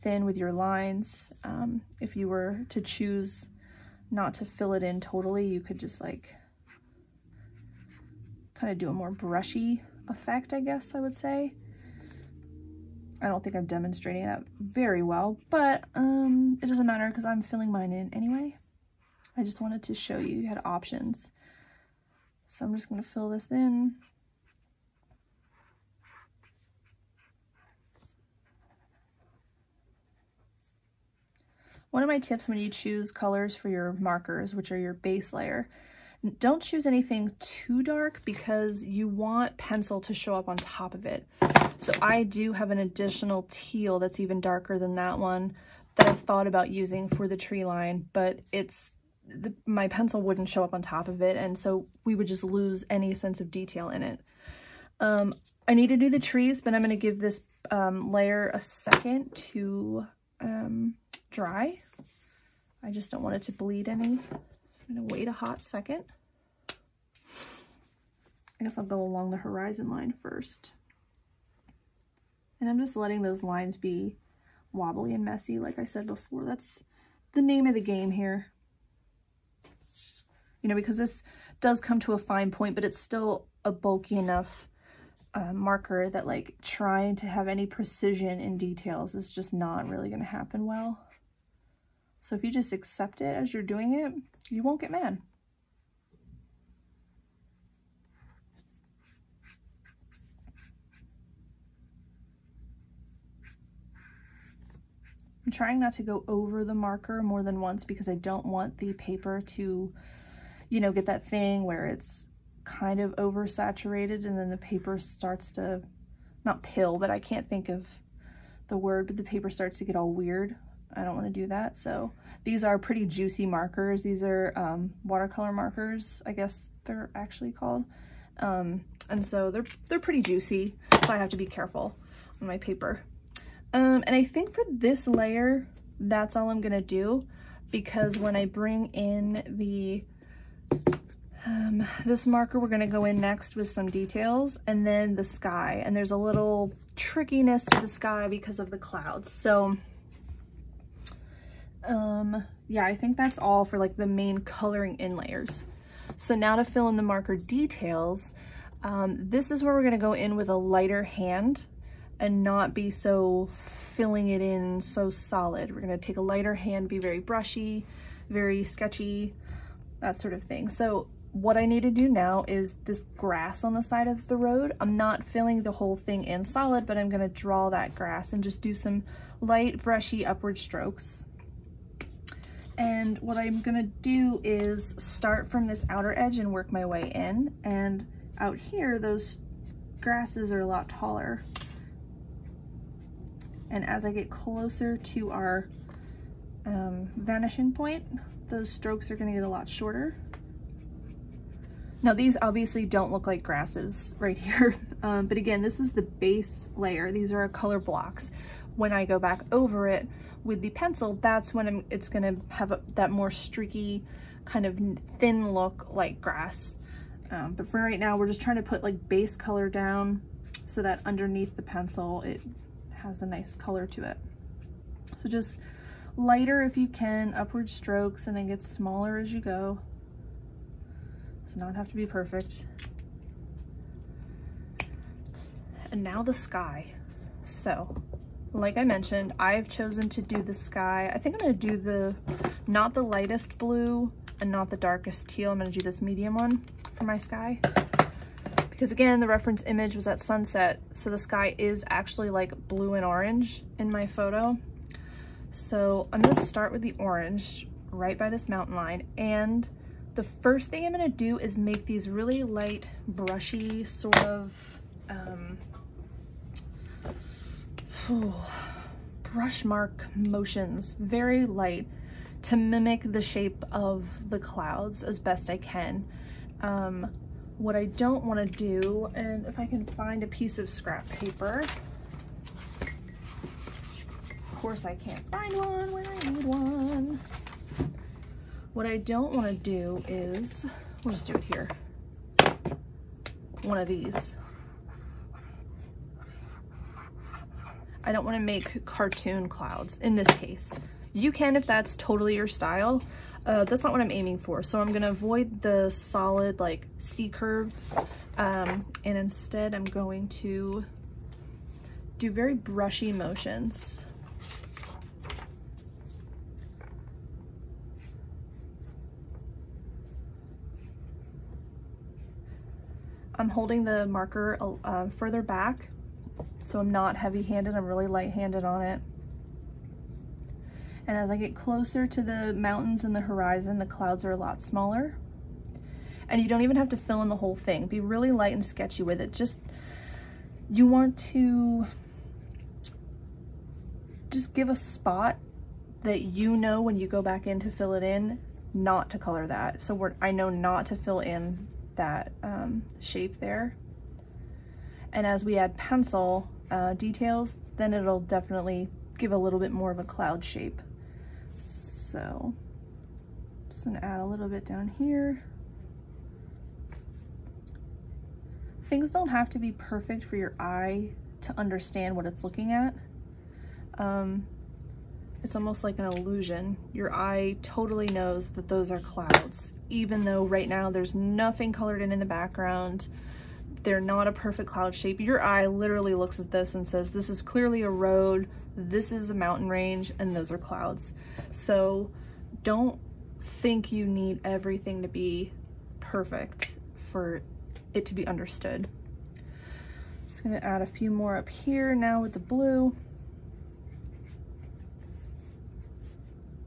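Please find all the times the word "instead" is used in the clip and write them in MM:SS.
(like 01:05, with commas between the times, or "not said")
05:09.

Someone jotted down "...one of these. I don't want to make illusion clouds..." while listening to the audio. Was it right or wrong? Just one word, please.
wrong.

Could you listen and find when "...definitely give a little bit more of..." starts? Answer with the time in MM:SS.
05:58.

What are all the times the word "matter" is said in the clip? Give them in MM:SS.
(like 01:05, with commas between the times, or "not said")
00:16.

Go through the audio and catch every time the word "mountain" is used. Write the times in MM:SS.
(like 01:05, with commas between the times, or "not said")
04:18, 05:32, 06:29.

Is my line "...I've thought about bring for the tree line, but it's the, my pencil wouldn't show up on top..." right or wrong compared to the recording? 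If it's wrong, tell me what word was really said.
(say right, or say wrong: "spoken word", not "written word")
wrong: "using", not "bring".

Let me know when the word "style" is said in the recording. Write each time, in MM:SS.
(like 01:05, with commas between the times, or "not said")
05:02.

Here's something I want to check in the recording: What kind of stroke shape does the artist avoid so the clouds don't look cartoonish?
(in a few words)
C-curve.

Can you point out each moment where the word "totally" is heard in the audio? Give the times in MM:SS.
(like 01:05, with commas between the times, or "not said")
00:04, 05:01, 06:17.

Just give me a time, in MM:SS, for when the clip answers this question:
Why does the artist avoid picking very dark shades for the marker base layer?
00:38.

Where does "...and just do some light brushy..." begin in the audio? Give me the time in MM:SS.
02:58.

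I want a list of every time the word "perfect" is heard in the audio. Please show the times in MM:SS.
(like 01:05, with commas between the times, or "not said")
03:52, 06:09, 06:24, 06:36.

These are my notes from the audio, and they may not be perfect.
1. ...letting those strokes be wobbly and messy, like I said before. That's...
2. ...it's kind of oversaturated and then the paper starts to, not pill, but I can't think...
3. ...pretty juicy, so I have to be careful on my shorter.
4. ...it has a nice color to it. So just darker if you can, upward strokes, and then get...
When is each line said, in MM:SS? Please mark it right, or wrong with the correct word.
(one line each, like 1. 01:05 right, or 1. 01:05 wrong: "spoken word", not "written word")
1. 01:12 wrong: "lines", not "strokes"
2. 01:51 right
3. 02:09 wrong: "paper", not "shorter"
4. 03:42 wrong: "lighter", not "darker".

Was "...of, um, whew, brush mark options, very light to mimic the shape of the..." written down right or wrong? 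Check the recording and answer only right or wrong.
wrong.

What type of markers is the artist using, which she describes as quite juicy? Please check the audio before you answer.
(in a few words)
Watercolor markers.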